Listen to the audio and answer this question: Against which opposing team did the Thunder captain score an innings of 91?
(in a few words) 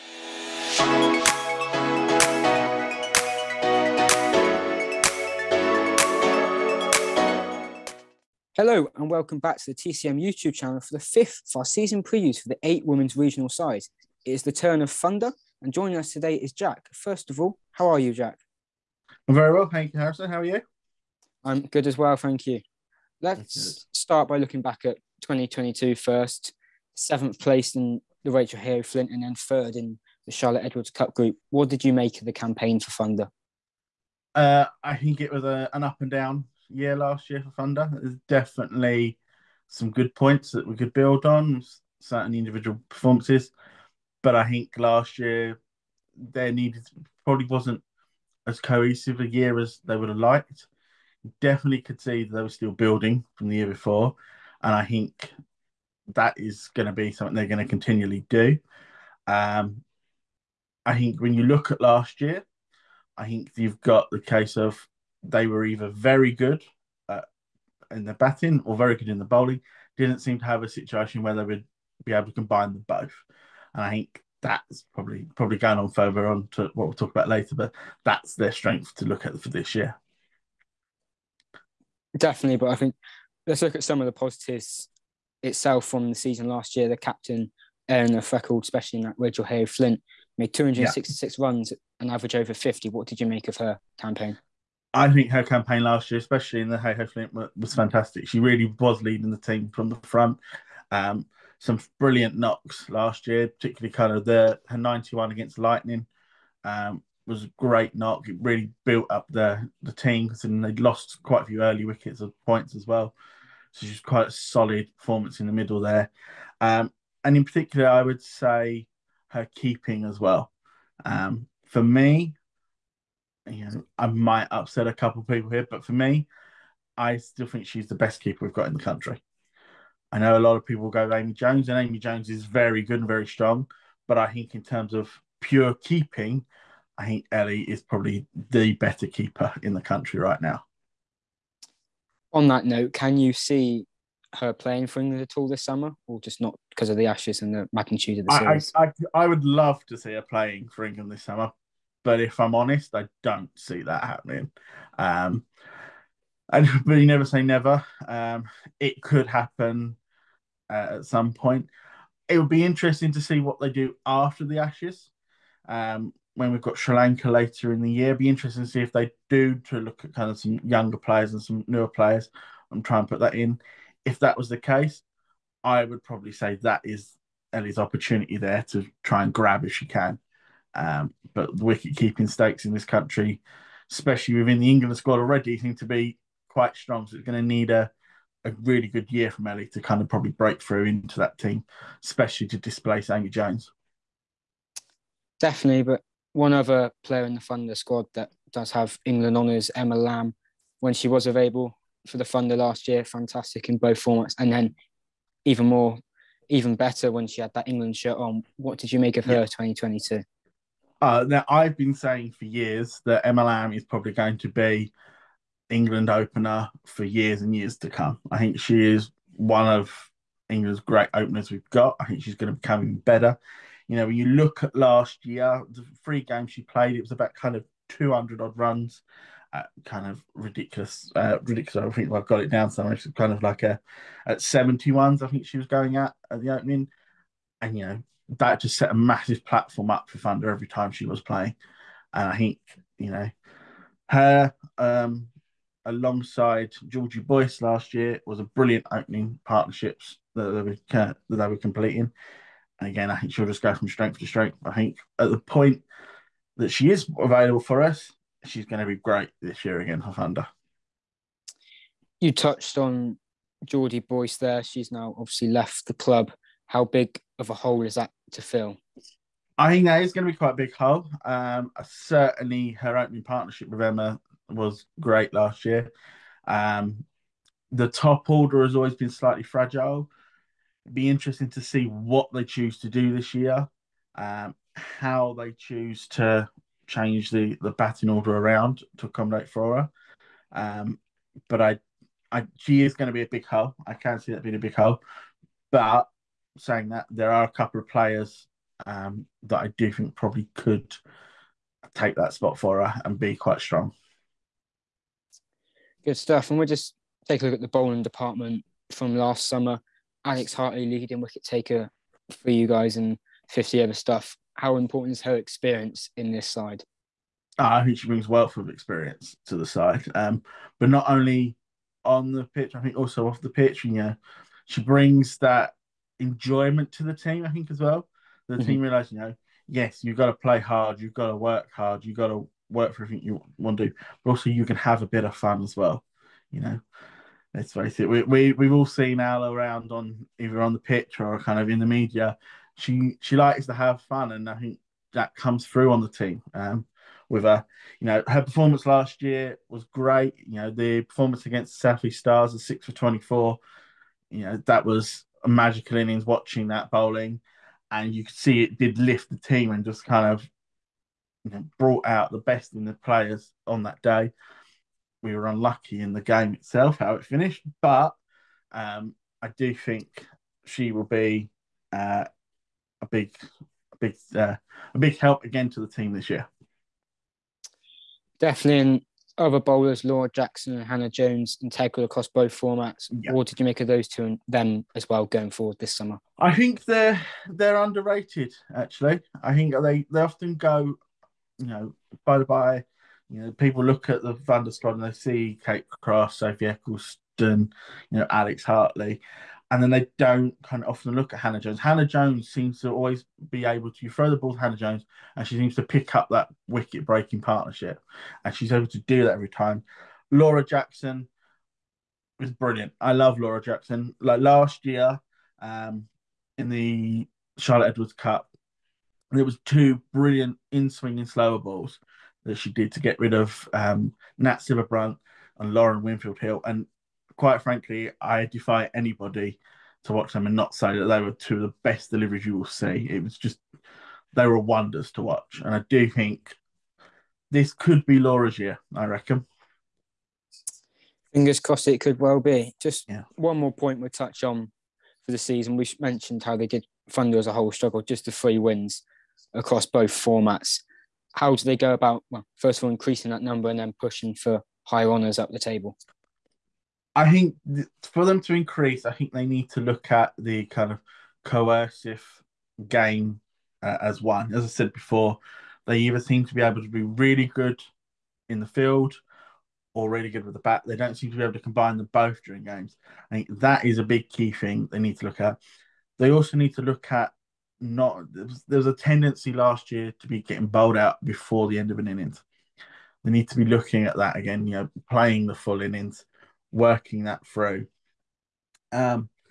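Lightning.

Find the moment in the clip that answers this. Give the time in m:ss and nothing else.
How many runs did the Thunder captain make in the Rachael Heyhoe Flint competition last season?
1:30.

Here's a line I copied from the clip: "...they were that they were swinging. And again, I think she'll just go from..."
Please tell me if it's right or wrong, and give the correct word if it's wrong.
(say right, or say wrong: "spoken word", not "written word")
wrong: "completing", not "swinging".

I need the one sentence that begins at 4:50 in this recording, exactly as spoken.
Um, but I, I she is going to be a big hole.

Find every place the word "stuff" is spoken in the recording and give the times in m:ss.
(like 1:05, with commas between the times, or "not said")
5:06, 5:13.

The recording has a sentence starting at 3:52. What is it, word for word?
It's kind of like a at seventy ones.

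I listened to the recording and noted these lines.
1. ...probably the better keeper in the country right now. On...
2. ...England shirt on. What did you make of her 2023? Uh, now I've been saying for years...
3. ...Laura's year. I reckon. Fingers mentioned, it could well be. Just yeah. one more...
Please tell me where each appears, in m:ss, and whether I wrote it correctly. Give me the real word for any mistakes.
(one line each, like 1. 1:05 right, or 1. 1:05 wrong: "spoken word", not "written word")
1. 2:17 right
2. 3:27 wrong: "2022", not "2023"
3. 7:18 wrong: "crossed", not "mentioned".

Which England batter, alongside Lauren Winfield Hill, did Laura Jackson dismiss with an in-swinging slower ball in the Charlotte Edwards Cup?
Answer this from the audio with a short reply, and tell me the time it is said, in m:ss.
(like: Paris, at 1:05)
Nat Sciver-Brunt, at 7:04.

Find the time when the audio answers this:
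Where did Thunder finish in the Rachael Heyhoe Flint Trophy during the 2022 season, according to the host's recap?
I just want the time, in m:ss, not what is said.
0:26.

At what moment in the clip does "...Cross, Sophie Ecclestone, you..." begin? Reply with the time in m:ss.
6:36.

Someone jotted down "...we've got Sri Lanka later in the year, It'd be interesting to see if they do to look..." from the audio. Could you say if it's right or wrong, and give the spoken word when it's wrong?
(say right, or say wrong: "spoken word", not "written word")
right.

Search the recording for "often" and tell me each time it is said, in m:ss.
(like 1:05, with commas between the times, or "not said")
6:30, 6:40.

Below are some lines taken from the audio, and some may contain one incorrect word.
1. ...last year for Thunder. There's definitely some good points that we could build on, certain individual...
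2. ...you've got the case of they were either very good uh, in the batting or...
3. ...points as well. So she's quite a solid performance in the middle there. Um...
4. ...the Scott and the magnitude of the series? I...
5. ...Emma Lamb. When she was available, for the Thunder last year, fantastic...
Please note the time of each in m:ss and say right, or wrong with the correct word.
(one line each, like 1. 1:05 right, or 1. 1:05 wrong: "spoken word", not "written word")
1. 0:36 right
2. 1:03 right
3. 1:52 right
4. 2:26 wrong: "Ashes", not "Scott"
5. 3:19 right.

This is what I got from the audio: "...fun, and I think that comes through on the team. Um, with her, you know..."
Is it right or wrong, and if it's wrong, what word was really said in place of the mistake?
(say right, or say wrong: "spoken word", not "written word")
right.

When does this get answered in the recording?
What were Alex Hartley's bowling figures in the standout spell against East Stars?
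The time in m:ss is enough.
5:52.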